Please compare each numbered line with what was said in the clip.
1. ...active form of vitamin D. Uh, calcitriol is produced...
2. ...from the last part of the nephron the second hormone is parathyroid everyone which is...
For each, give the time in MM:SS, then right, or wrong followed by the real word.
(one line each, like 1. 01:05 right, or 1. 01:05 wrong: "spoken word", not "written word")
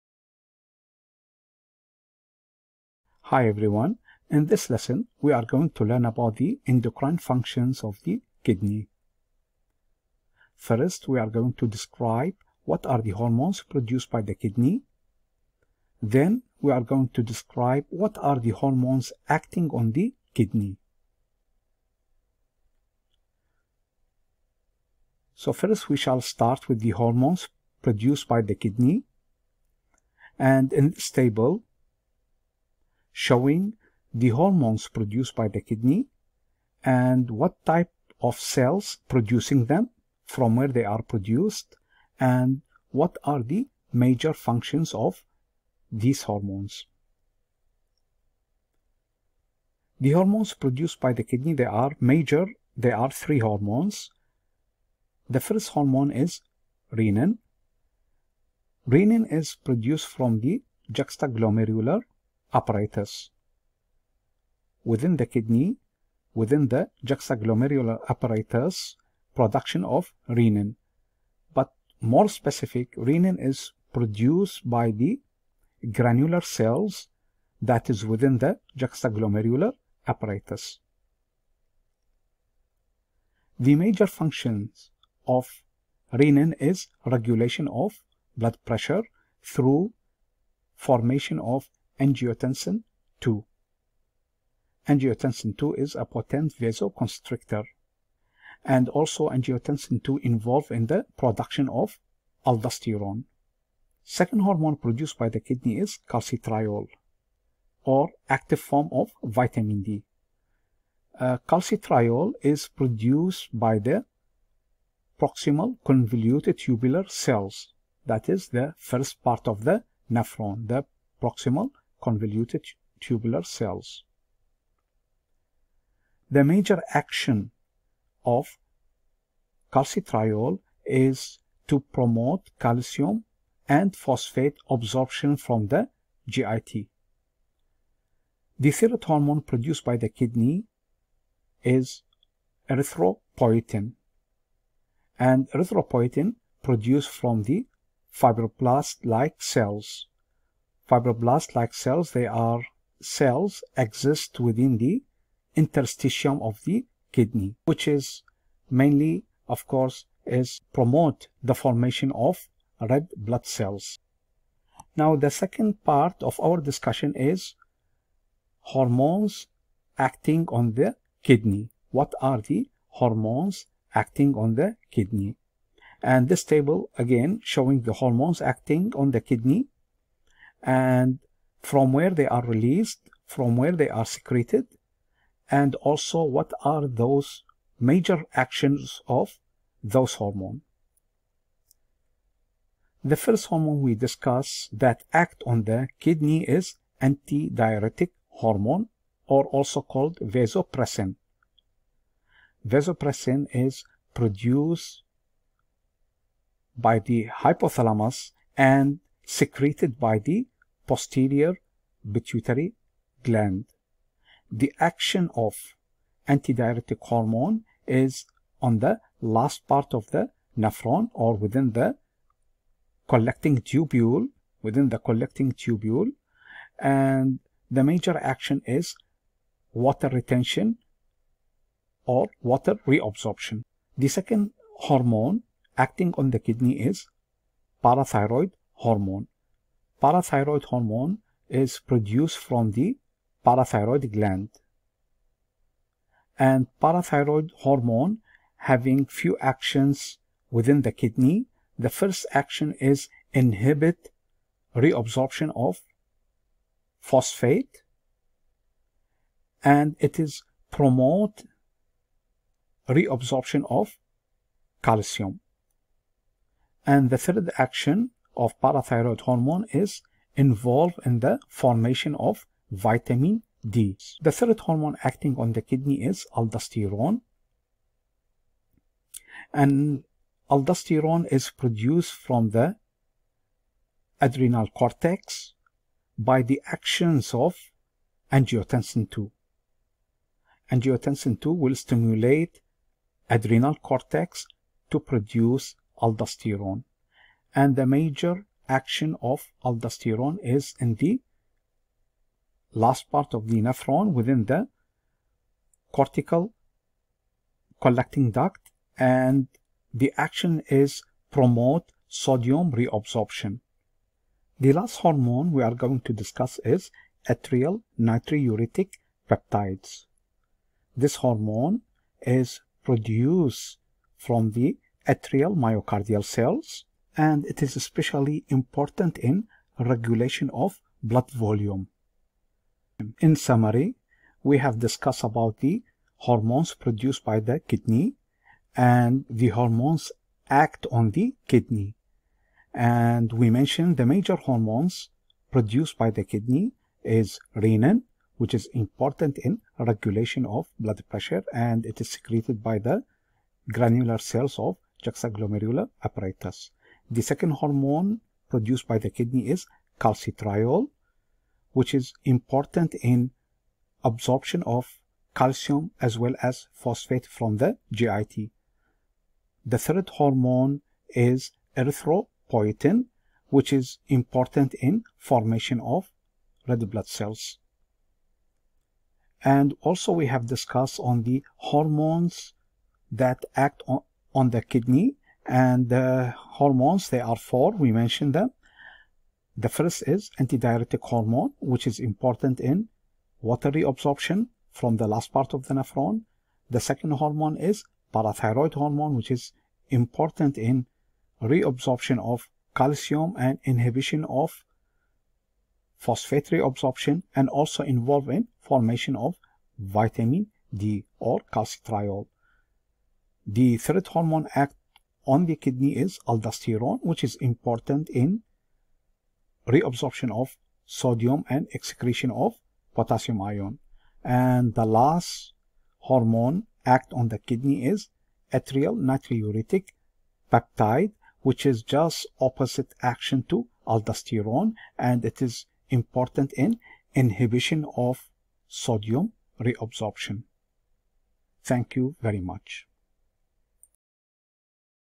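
1. 01:48 right
2. 06:34 wrong: "hormone", not "everyone".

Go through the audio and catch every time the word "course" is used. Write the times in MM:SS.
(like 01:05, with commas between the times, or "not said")
02:39.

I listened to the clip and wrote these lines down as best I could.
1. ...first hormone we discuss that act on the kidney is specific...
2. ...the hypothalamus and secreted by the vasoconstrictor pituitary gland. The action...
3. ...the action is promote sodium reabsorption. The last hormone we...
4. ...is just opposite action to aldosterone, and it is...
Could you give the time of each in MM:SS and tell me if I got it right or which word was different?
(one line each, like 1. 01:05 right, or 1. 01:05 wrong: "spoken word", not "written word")
1. 03:13 wrong: "antidiuretic", not "specific"
2. 03:26 wrong: "posterior", not "vasoconstrictor"
3. 05:09 right
4. 07:11 right.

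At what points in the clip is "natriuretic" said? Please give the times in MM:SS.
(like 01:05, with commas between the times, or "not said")
05:17, 07:08.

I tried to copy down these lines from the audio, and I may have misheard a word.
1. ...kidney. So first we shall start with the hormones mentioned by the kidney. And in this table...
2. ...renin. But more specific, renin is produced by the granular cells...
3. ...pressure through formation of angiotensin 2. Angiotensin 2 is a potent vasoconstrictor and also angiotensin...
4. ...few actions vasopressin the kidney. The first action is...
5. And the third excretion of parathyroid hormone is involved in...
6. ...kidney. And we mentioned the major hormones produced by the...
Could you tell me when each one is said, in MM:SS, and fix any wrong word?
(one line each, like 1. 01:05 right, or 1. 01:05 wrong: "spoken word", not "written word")
1. 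00:20 wrong: "produced", not "mentioned"
2. 01:10 right
3. 01:28 right
4. 04:09 wrong: "within", not "vasopressin"
5. 04:26 wrong: "action", not "excretion"
6. 05:41 right.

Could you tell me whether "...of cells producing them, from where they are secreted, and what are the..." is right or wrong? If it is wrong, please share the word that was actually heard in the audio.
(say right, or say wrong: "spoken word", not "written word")
wrong: "produced", not "secreted".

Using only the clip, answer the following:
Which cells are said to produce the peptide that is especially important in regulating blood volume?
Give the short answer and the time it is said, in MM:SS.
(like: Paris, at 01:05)
Atrial myocardial cells, at 05:25.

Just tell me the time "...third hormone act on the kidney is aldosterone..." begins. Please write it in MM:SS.
06:53.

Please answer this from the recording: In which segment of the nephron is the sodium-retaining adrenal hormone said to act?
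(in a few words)
Cortical collecting duct.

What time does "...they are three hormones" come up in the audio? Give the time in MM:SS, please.
00:52.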